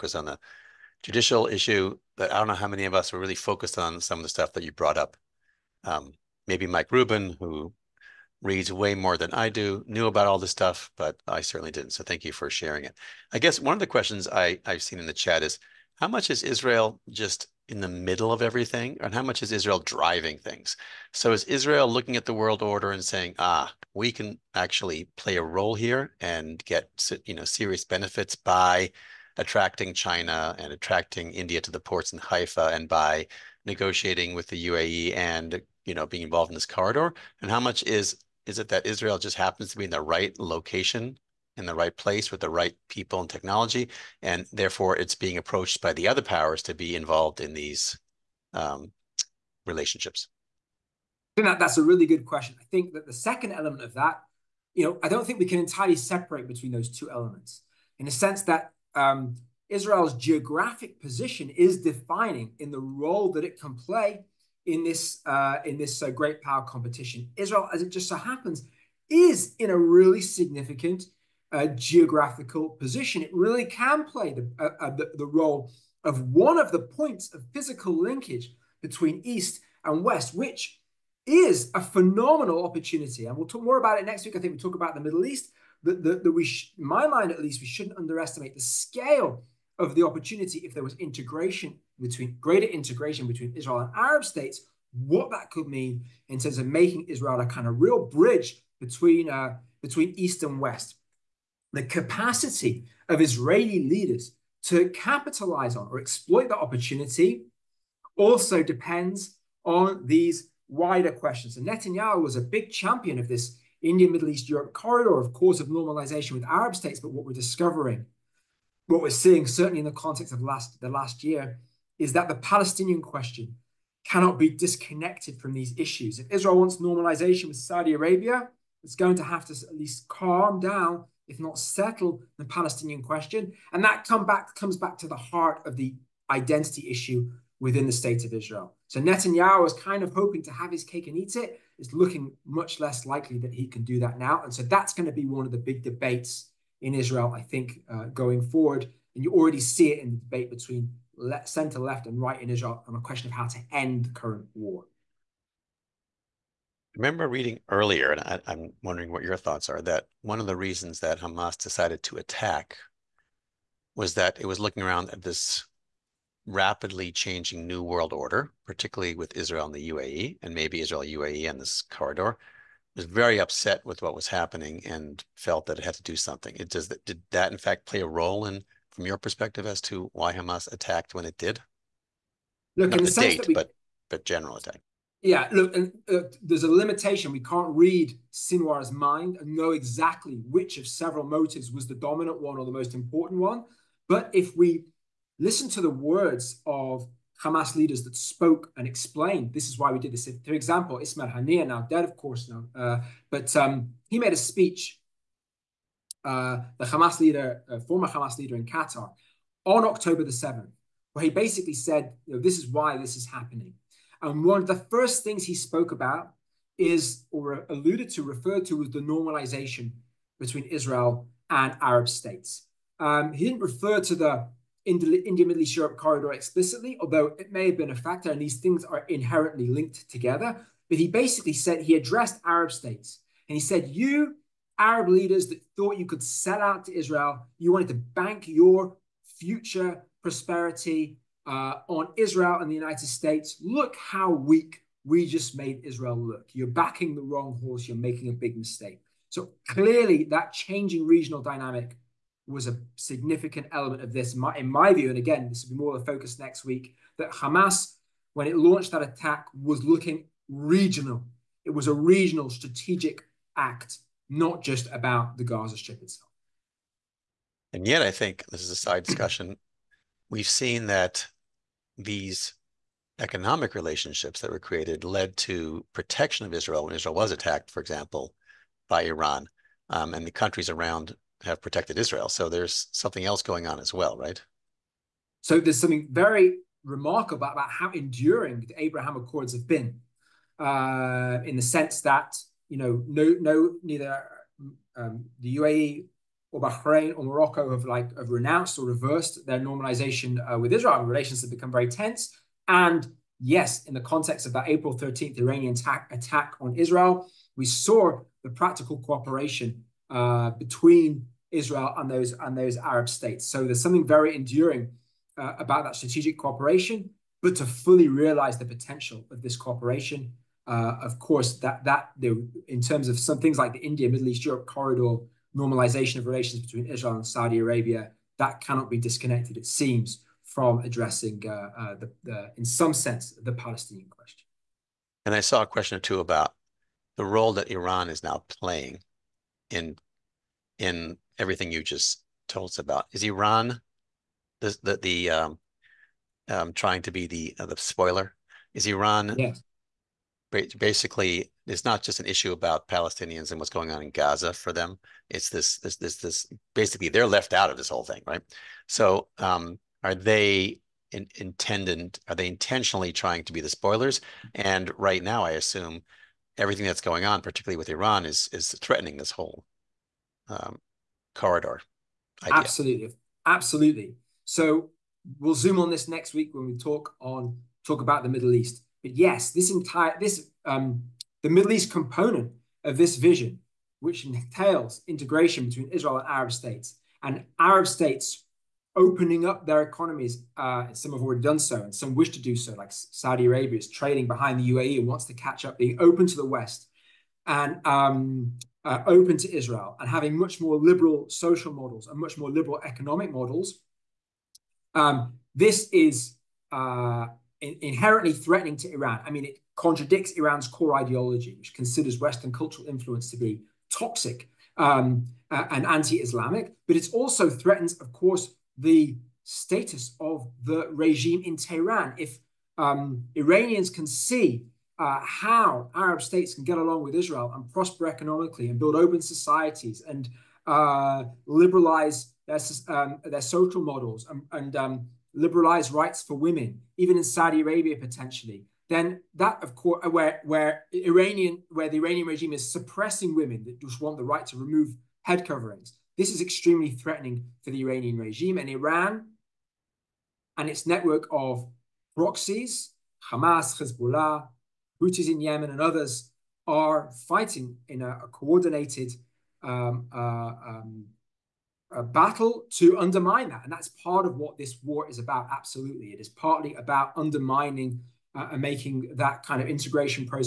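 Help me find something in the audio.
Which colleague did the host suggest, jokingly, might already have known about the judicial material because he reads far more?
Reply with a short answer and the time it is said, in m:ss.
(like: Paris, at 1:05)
Mike Rubin, at 0:06.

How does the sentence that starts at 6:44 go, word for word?
Um, this is uh, in inherently threatening to Iran.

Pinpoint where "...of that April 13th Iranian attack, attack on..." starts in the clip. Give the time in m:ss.
5:04.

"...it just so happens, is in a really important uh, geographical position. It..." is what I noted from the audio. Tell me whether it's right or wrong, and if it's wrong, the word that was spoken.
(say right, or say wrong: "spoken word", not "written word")
wrong: "significant", not "important".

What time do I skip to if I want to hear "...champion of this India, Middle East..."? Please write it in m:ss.
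1:52.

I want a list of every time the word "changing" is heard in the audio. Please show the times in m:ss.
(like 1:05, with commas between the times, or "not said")
2:47, 4:10.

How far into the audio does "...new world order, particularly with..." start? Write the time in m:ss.
2:47.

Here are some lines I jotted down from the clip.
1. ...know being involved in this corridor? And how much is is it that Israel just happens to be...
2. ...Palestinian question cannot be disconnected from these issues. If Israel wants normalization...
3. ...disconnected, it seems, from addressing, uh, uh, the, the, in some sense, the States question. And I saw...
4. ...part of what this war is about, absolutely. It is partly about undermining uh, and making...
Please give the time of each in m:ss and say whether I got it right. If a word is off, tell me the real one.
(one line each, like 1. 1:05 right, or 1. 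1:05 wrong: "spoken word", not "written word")
1. 0:35 right
2. 2:02 right
3. 5:28 wrong: "Palestinian", not "States"
4. 7:43 right.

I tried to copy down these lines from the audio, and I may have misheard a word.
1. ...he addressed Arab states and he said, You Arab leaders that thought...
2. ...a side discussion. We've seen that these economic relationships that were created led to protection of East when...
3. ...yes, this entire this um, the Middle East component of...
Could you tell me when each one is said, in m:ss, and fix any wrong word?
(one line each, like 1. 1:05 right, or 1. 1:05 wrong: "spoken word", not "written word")
1. 3:51 right
2. 4:28 wrong: "Israel", not "East"
3. 6:19 right.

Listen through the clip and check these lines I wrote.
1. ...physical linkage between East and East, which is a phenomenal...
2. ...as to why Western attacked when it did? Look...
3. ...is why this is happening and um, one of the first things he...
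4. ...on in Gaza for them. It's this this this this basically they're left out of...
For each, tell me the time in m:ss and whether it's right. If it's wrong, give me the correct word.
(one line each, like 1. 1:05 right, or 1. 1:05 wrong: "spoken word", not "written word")
1. 1:17 wrong: "West", not "East"
2. 2:59 wrong: "Hamas", not "Western"
3. 3:32 right
4. 5:53 right.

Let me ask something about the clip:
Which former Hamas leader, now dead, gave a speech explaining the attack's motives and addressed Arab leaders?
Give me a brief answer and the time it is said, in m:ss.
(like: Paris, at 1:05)
Ismail Haniyeh, at 3:20.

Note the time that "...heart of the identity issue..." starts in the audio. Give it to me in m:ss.
2:15.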